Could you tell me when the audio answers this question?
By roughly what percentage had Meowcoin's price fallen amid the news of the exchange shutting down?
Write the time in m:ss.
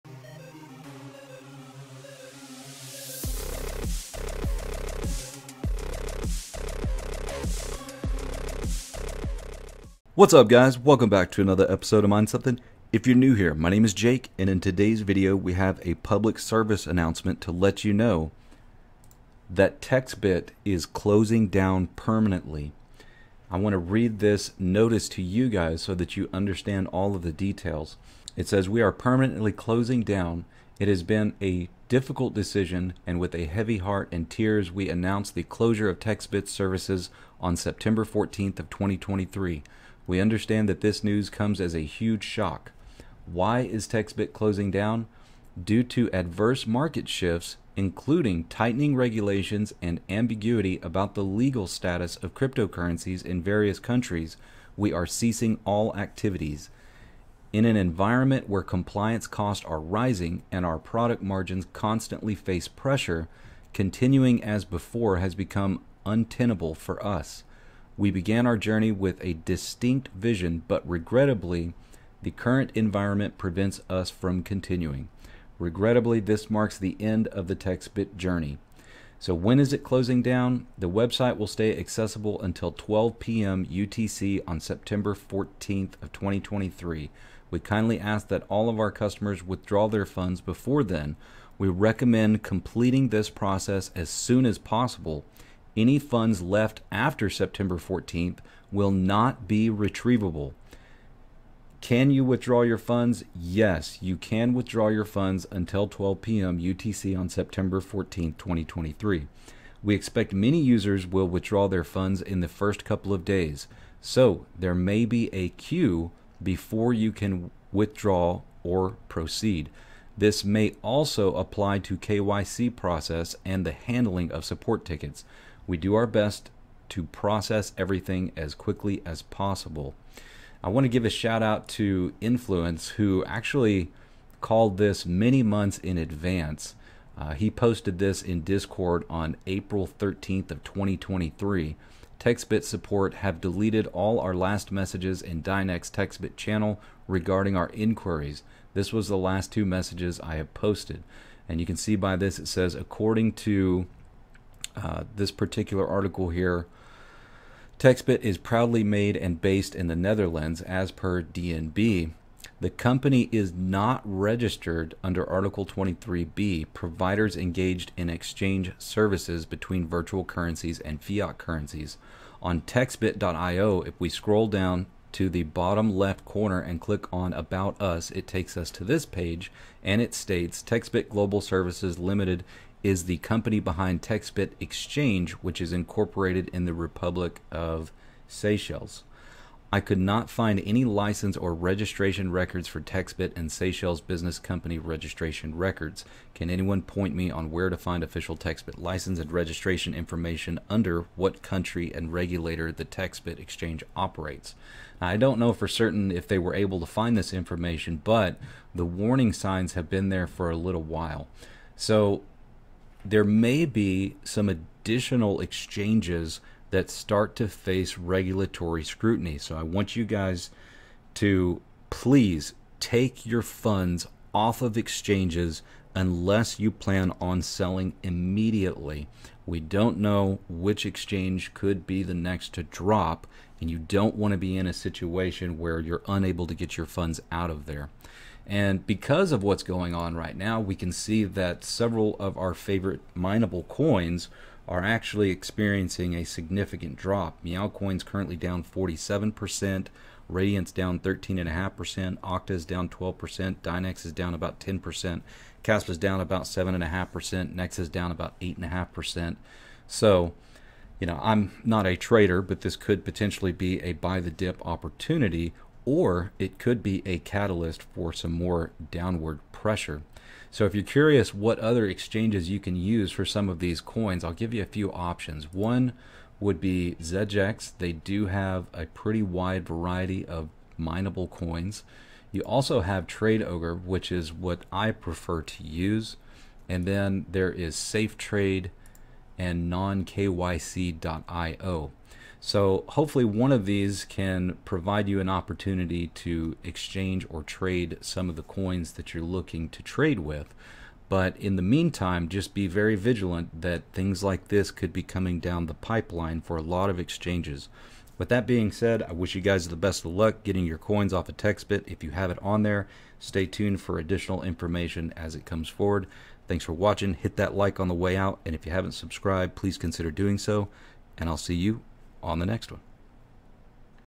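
4:08.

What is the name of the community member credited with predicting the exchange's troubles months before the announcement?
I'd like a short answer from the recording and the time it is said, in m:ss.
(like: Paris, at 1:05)
Influence, at 2:12.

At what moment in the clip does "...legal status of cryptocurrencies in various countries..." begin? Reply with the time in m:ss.
0:51.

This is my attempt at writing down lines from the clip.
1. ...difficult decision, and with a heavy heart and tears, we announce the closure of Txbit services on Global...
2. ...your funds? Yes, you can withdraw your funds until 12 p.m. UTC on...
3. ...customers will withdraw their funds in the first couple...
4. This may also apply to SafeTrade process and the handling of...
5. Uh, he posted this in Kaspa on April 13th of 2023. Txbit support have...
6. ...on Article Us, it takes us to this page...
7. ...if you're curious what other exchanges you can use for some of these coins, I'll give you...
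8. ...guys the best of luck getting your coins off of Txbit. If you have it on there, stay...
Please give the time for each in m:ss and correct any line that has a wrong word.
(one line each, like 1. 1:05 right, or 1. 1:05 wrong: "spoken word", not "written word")
1. 0:31 wrong: "September", not "Global"
2. 1:42 right
3. 1:50 wrong: "users", not "customers"
4. 2:00 wrong: "KYC", not "SafeTrade"
5. 2:17 wrong: "Discord", not "Kaspa"
6. 2:57 wrong: "About", not "Article"
7. 4:30 right
8. 5:09 right.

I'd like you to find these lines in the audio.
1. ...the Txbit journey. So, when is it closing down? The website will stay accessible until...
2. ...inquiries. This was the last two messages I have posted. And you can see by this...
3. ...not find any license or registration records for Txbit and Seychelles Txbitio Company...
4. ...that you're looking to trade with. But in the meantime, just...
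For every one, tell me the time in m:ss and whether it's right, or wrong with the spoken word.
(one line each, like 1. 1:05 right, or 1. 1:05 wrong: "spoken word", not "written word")
1. 1:17 right
2. 2:27 right
3. 3:09 wrong: "Business", not "Txbitio"
4. 4:58 right.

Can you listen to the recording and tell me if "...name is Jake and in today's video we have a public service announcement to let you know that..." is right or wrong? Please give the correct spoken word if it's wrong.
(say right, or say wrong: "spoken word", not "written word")
right.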